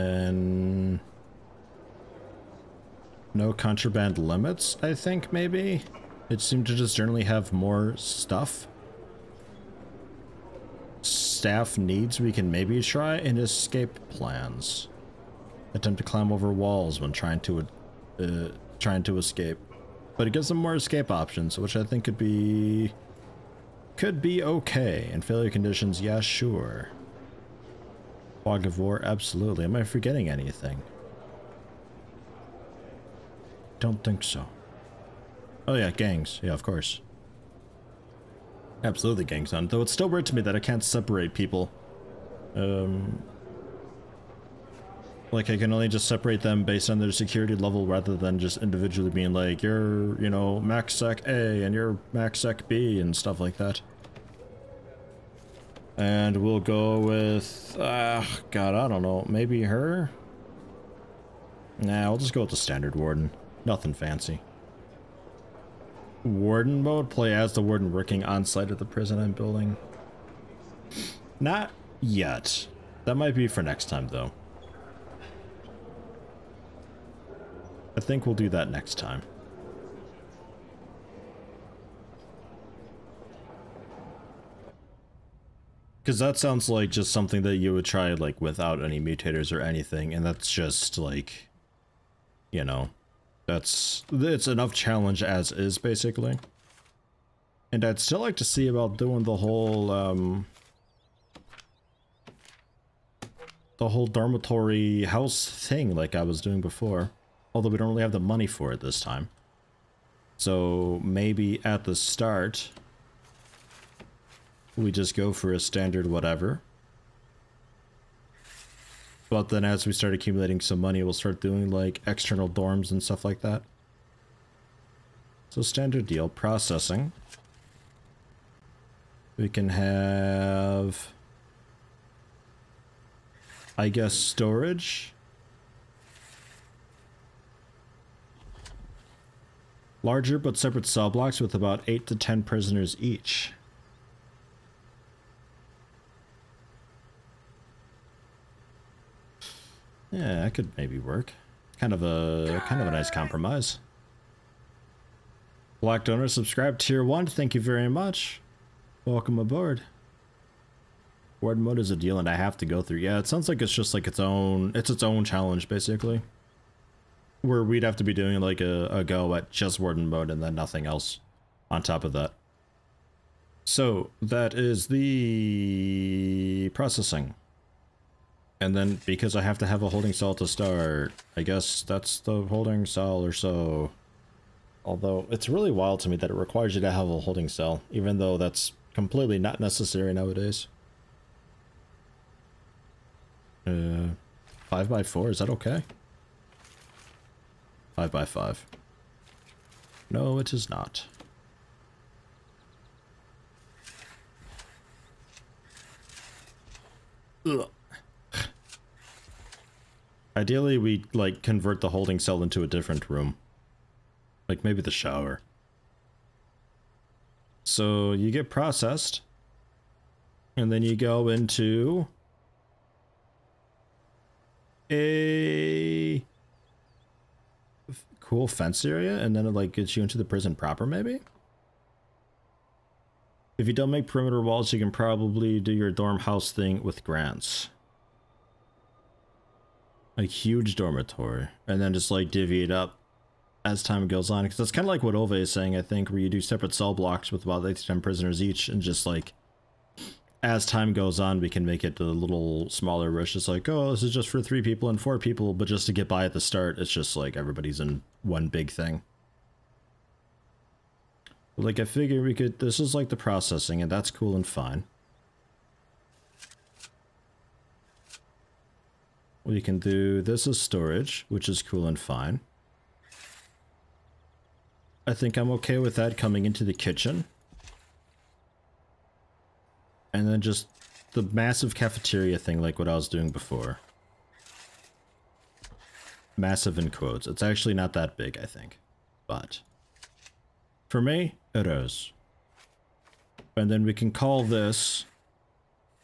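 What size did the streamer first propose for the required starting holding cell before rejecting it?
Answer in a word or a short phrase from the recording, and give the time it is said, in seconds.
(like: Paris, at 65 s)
5 by 4, at 194 s.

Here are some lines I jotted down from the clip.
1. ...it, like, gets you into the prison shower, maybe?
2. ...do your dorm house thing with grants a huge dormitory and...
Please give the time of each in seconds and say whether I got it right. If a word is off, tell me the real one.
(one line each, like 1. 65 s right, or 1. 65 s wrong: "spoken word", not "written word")
1. 229 s wrong: "proper", not "shower"
2. 235 s right.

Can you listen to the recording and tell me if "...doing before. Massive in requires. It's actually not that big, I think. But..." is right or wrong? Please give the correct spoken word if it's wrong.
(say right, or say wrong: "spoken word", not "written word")
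wrong: "quotes", not "requires".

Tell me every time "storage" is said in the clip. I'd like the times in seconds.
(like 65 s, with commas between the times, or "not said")
134 s, 270 s.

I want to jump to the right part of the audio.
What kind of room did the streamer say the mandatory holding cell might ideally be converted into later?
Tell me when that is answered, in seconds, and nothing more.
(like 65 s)
214 s.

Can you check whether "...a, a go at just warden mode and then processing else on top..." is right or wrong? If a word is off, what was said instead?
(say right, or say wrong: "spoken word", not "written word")
wrong: "nothing", not "processing".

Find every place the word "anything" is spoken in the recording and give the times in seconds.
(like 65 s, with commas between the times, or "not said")
30 s, 89 s.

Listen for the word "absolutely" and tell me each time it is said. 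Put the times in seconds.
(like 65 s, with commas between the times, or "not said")
29 s, 38 s.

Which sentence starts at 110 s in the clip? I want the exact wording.
So maybe at the start we just go for a standard whatever.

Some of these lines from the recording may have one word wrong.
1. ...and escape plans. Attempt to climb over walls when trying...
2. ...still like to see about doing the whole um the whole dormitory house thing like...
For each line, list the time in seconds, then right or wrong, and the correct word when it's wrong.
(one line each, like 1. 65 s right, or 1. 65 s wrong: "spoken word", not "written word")
1. 13 s right
2. 97 s right.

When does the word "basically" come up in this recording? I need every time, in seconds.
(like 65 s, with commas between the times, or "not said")
95 s, 165 s.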